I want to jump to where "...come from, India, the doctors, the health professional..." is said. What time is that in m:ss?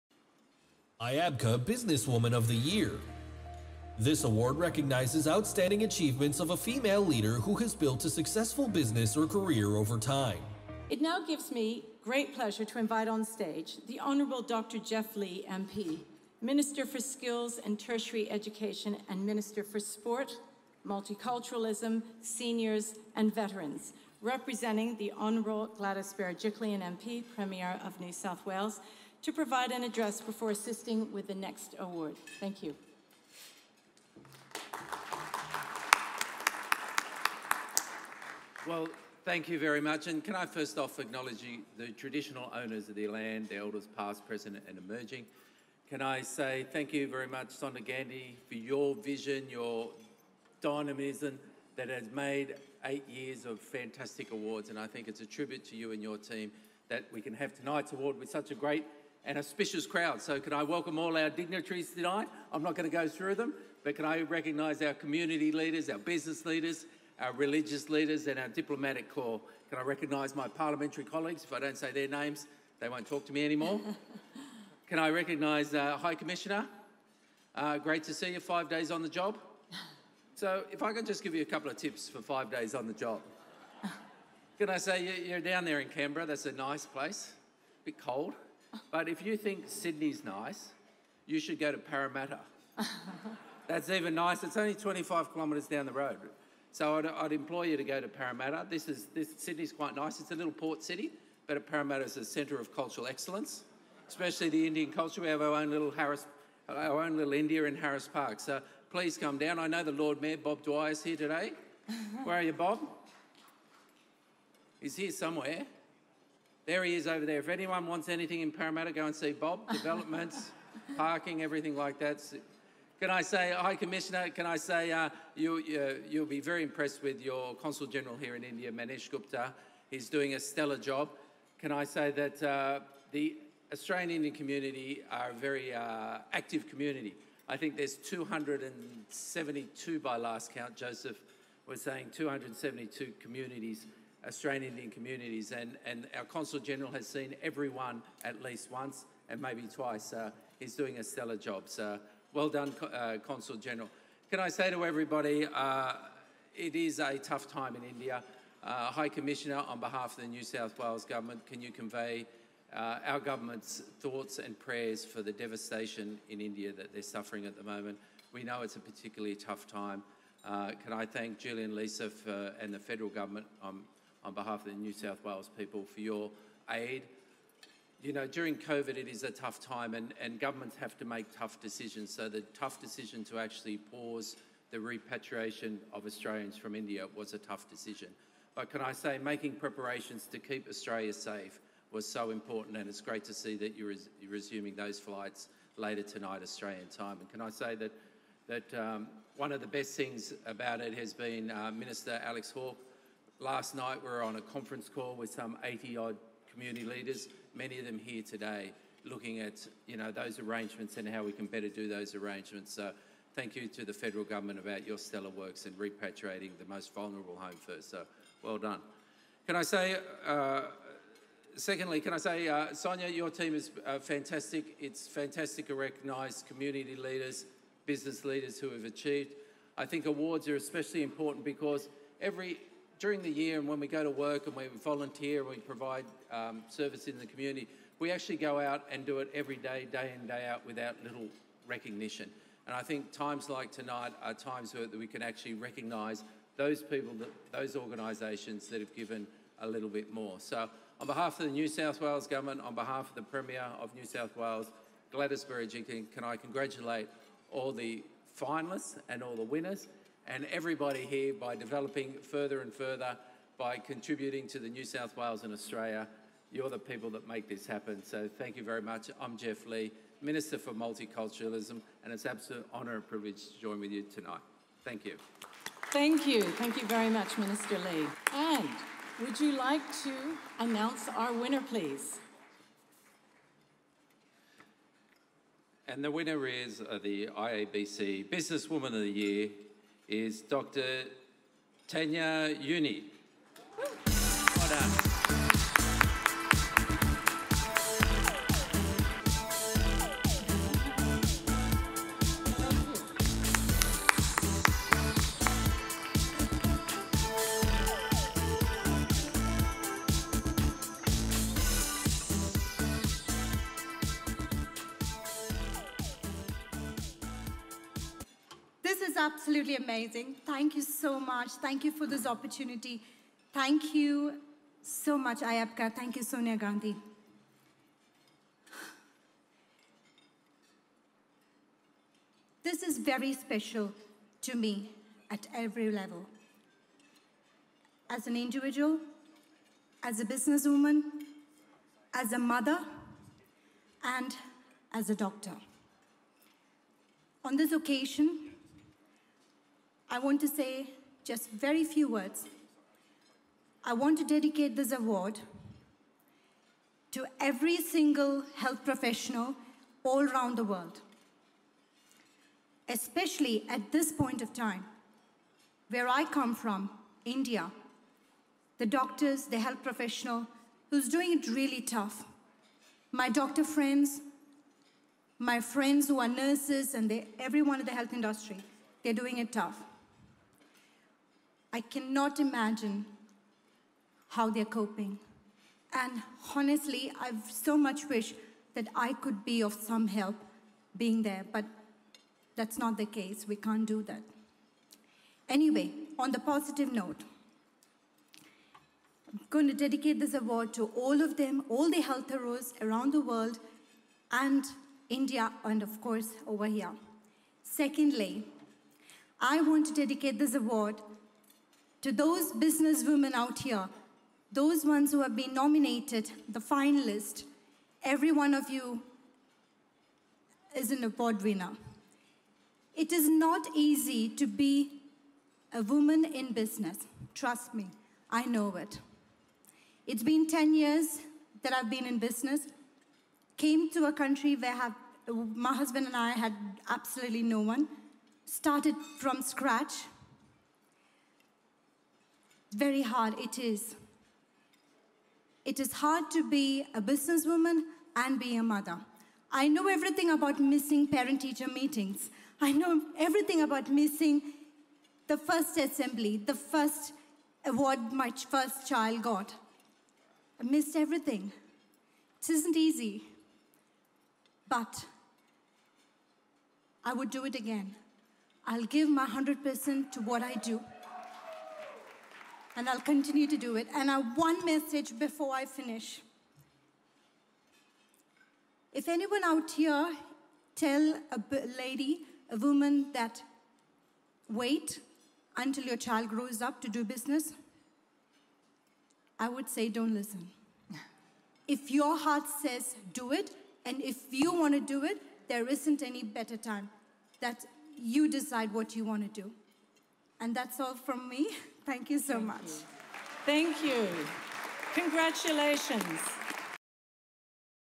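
6:06.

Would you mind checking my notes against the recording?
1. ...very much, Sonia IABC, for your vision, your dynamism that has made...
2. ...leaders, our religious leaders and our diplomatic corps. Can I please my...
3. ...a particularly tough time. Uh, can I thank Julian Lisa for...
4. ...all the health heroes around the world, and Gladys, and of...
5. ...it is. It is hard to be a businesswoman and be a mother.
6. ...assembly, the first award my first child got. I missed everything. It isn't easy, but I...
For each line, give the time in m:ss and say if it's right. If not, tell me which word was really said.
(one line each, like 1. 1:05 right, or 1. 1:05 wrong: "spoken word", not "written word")
1. 0:47 wrong: "Gandhi", not "IABC"
2. 1:06 wrong: "recognise", not "please"
3. 2:48 right
4. 6:41 wrong: "India", not "Gladys"
5. 7:23 right
6. 7:35 right.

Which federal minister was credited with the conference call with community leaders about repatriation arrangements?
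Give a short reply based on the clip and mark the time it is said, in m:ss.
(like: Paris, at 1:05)
Alex Hawke, at 3:22.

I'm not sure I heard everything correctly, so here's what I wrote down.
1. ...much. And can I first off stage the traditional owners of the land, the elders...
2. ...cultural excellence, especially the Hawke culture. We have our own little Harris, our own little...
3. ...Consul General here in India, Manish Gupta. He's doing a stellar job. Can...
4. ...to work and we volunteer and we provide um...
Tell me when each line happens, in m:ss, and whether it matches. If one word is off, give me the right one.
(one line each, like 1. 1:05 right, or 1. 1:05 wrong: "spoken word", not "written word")
1. 0:39 wrong: "acknowledge", not "stage"
2. 1:42 wrong: "Indian", not "Hawke"
3. 2:07 right
4. 3:54 right.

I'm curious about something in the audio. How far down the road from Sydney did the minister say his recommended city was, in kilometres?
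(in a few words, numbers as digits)
25.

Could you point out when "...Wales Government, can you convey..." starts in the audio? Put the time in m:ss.
2:40.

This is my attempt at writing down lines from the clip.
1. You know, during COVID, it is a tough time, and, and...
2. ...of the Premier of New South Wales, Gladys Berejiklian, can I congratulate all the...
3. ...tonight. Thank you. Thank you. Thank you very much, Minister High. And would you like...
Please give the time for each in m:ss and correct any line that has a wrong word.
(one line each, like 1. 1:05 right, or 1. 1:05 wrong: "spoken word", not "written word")
1. 2:58 right
2. 4:13 right
3. 4:34 wrong: "Lee", not "High".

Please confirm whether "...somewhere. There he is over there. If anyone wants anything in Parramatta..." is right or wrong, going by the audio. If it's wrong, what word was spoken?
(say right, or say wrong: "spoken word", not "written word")
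right.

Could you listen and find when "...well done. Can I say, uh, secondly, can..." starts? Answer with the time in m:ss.
3:38.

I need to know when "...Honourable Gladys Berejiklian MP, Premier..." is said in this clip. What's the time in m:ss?
0:25.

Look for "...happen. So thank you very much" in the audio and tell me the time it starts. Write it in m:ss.
4:27.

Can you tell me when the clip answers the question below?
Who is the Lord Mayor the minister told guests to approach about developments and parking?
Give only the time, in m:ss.
1:50.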